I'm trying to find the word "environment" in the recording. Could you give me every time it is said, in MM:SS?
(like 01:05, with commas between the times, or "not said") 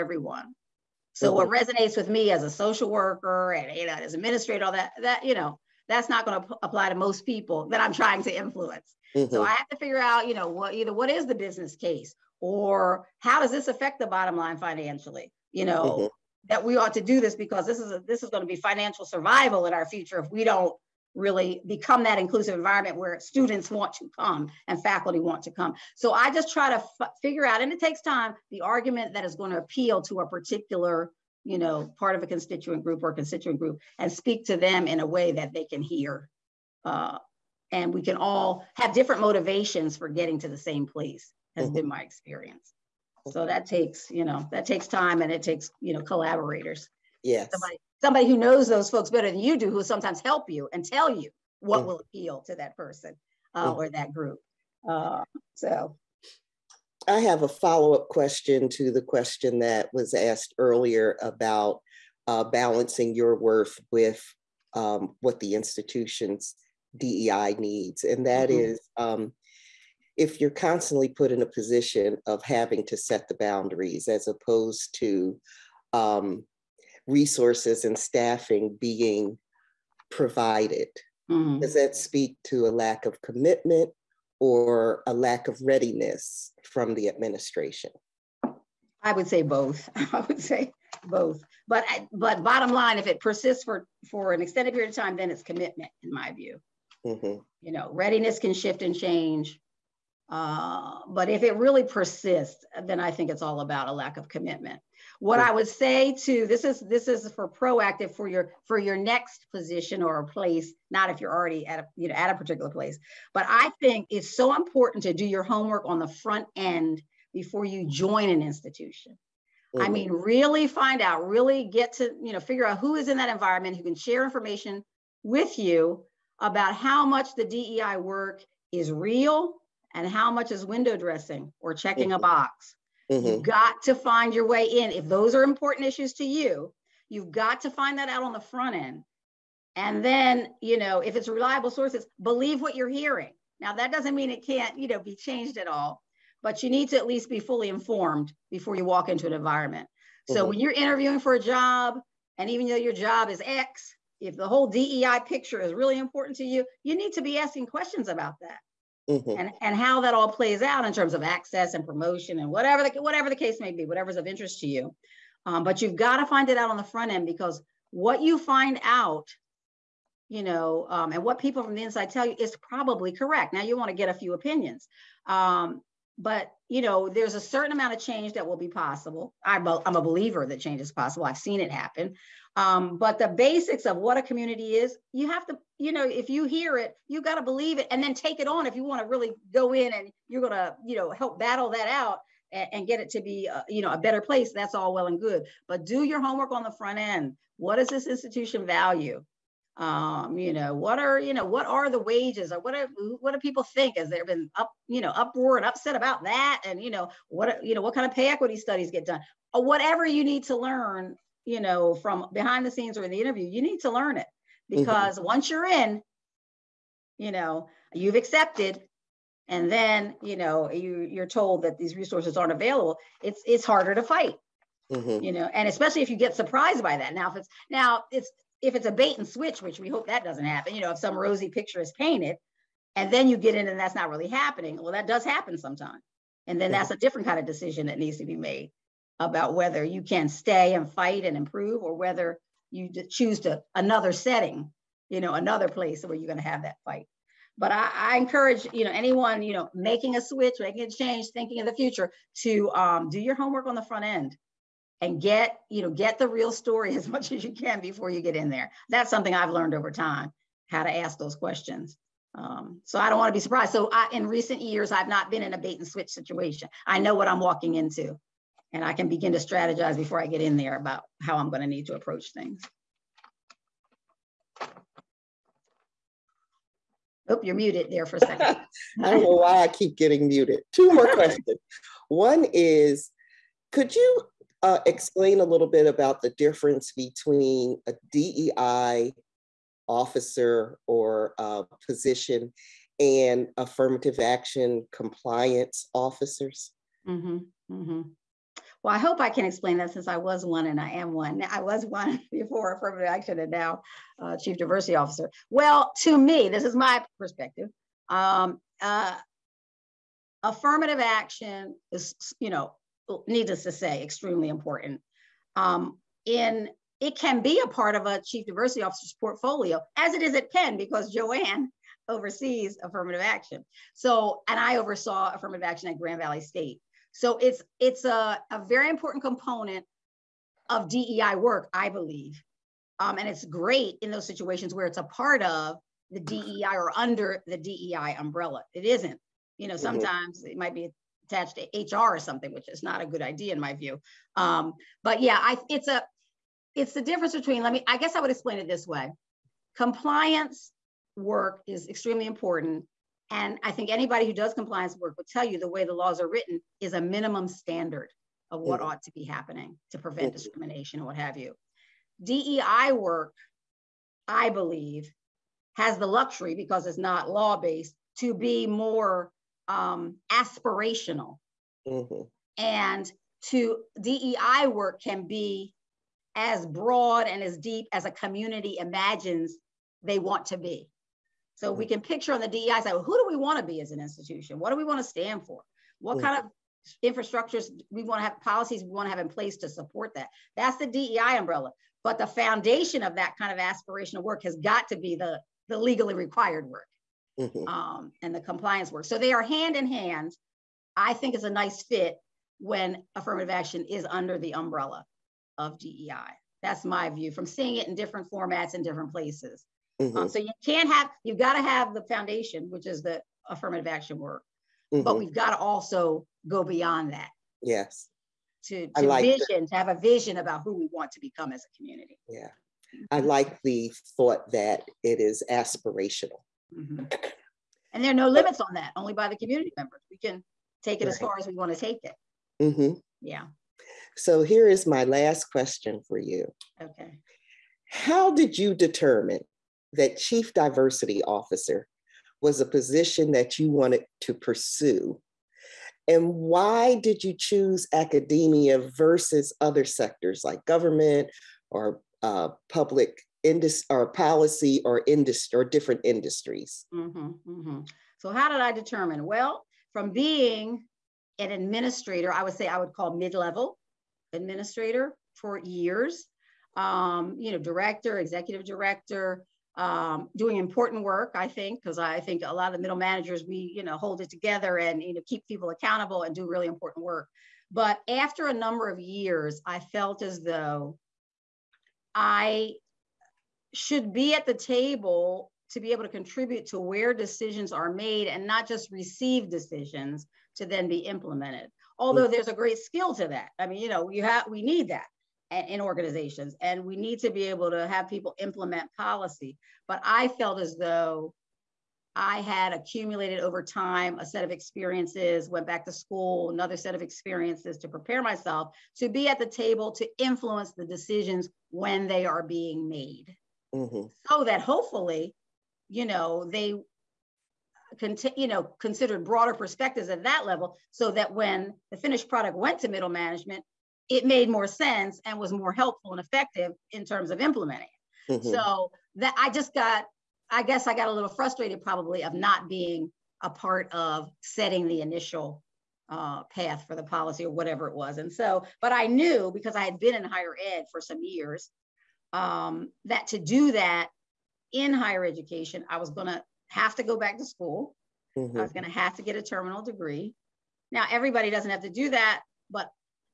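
00:22, 02:03, 02:29.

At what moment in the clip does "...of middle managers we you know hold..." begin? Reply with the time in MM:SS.
07:52.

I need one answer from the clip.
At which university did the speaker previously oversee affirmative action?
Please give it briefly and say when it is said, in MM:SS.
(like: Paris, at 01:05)
Grand Valley State, at 05:25.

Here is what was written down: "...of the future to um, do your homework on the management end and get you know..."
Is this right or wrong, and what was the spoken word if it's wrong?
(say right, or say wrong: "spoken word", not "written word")
wrong: "front", not "management".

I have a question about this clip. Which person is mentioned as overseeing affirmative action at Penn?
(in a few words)
Joanne.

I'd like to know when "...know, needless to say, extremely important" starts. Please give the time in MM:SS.
05:12.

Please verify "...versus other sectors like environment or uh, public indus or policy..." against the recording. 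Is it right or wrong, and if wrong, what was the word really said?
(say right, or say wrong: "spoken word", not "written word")
wrong: "government", not "environment".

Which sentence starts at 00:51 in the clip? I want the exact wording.
will appeal to that person uh, mm.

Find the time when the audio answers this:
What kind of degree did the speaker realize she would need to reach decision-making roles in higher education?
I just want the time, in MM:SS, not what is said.
09:09.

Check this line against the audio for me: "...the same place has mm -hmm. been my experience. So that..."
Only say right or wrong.
right.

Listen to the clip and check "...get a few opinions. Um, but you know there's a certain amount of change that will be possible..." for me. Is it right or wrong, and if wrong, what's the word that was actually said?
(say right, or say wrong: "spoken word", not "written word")
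right.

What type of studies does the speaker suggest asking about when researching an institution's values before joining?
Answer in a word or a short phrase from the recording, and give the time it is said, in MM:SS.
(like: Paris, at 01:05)
pay equity studies, at 03:28.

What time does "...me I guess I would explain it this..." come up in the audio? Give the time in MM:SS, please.
05:47.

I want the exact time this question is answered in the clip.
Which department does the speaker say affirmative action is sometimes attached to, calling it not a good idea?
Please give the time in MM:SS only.
05:41.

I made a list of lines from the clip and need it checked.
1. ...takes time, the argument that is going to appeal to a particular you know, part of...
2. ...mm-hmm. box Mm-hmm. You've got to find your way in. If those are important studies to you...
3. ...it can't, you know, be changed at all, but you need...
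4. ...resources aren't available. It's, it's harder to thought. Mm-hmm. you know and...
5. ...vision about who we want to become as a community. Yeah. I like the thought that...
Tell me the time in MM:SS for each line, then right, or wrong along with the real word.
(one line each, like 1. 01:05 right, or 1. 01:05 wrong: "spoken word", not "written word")
1. 00:27 right
2. 02:12 wrong: "issues", not "studies"
3. 02:24 right
4. 03:41 wrong: "fight", not "thought"
5. 07:00 right.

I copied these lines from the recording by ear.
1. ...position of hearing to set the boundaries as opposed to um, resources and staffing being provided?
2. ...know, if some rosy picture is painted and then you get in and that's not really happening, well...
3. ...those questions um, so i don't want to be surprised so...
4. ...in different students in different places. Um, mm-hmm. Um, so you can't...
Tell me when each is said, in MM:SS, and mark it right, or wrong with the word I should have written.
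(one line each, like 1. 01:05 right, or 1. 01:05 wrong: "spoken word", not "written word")
1. 01:11 wrong: "having", not "hearing"
2. 03:50 right
3. 04:21 right
4. 06:47 wrong: "formats", not "students".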